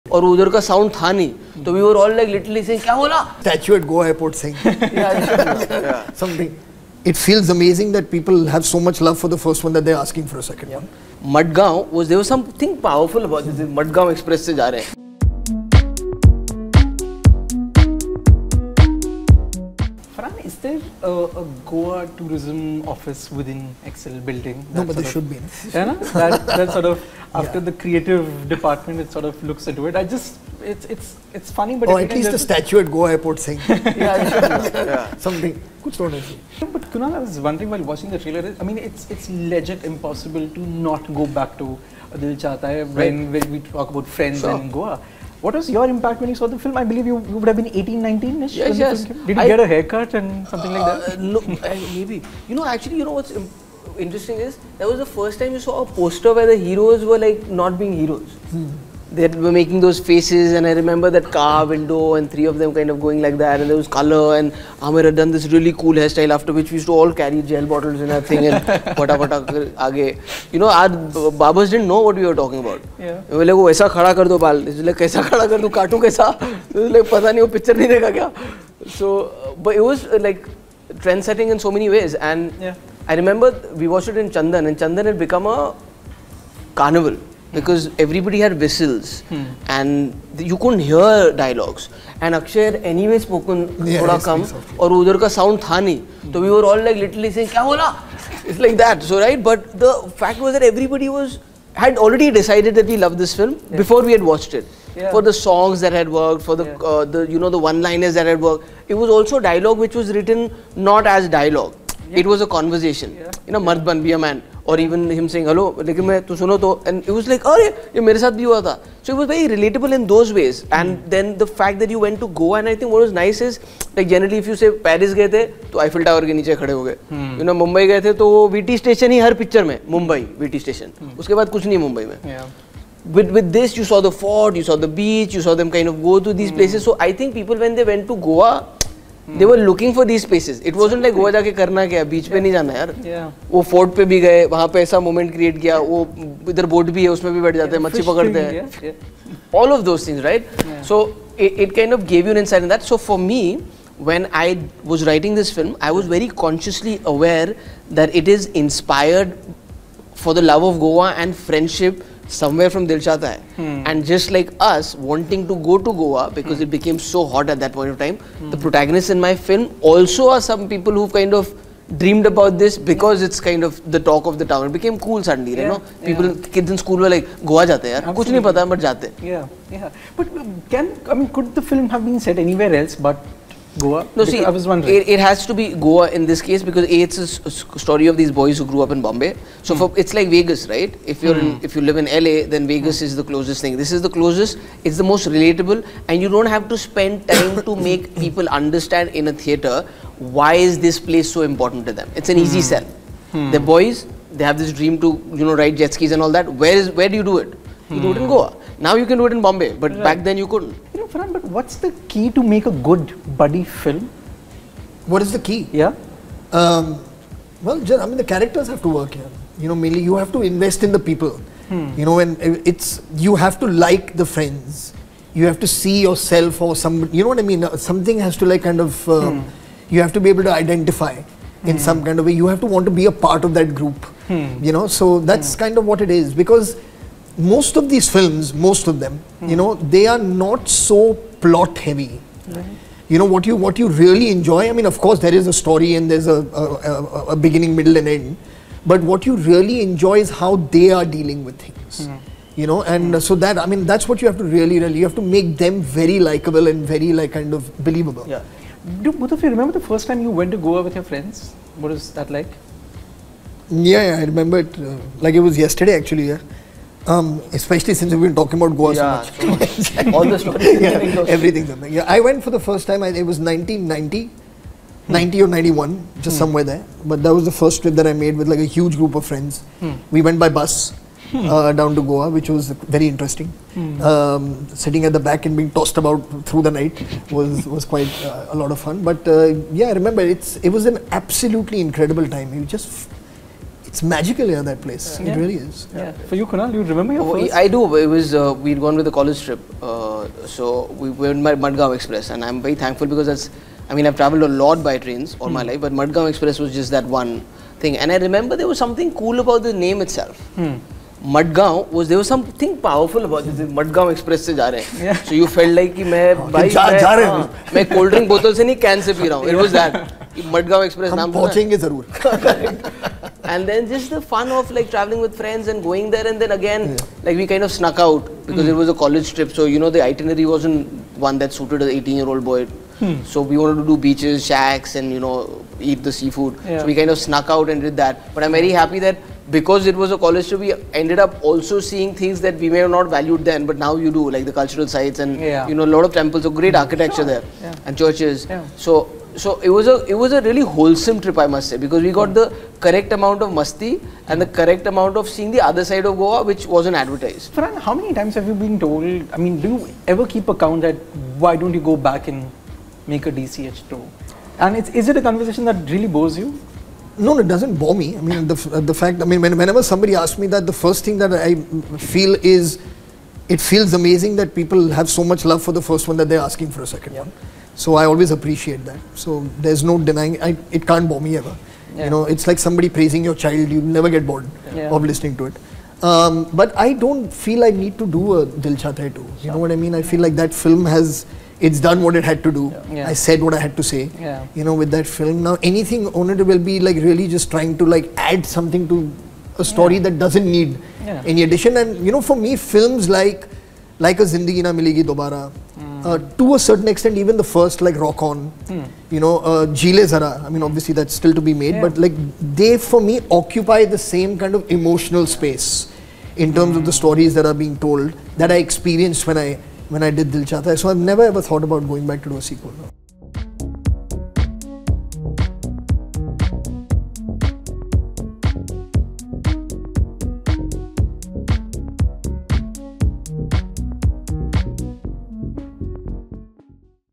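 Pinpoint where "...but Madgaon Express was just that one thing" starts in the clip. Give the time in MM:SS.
05:05.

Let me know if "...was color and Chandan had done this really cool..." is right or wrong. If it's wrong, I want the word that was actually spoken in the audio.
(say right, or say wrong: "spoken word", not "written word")
wrong: "Aamir", not "Chandan".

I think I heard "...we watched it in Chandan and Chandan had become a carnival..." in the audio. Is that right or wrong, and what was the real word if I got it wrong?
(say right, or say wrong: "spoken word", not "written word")
right.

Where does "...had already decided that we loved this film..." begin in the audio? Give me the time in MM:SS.
01:41.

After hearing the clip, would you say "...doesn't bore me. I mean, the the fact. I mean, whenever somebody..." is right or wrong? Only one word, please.
right.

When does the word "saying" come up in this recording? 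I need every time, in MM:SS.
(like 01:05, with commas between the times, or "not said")
00:33, 01:37.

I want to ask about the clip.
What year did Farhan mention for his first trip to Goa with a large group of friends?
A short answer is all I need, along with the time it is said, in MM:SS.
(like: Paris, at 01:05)
1990, at 04:33.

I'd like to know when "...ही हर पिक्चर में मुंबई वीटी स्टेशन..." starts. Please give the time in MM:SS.
02:09.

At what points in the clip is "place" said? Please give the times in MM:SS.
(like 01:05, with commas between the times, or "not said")
02:16, 03:20, 04:54.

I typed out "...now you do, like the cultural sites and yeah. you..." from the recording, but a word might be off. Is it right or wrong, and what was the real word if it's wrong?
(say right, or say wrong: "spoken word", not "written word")
right.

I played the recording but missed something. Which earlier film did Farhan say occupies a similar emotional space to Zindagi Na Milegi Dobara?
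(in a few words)
Rock On.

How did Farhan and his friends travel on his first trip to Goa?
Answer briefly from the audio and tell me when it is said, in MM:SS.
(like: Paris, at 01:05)
By bus, at 04:40.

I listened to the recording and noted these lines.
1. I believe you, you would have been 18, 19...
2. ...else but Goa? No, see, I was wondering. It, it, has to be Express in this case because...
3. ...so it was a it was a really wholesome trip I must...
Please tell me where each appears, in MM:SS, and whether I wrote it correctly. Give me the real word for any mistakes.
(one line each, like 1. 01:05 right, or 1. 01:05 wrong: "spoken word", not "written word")
1. 00:46 right
2. 03:02 wrong: "Goa", not "Express"
3. 05:49 right.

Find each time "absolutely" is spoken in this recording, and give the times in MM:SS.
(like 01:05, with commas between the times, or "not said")
02:57, 04:51.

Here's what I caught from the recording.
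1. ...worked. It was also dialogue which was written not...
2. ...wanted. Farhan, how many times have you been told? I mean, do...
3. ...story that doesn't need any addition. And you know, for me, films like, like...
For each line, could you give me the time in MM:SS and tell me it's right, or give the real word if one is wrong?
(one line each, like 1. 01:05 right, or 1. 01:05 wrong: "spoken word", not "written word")
1. 01:48 right
2. 05:56 wrong: "advertised", not "wanted"
3. 06:39 right.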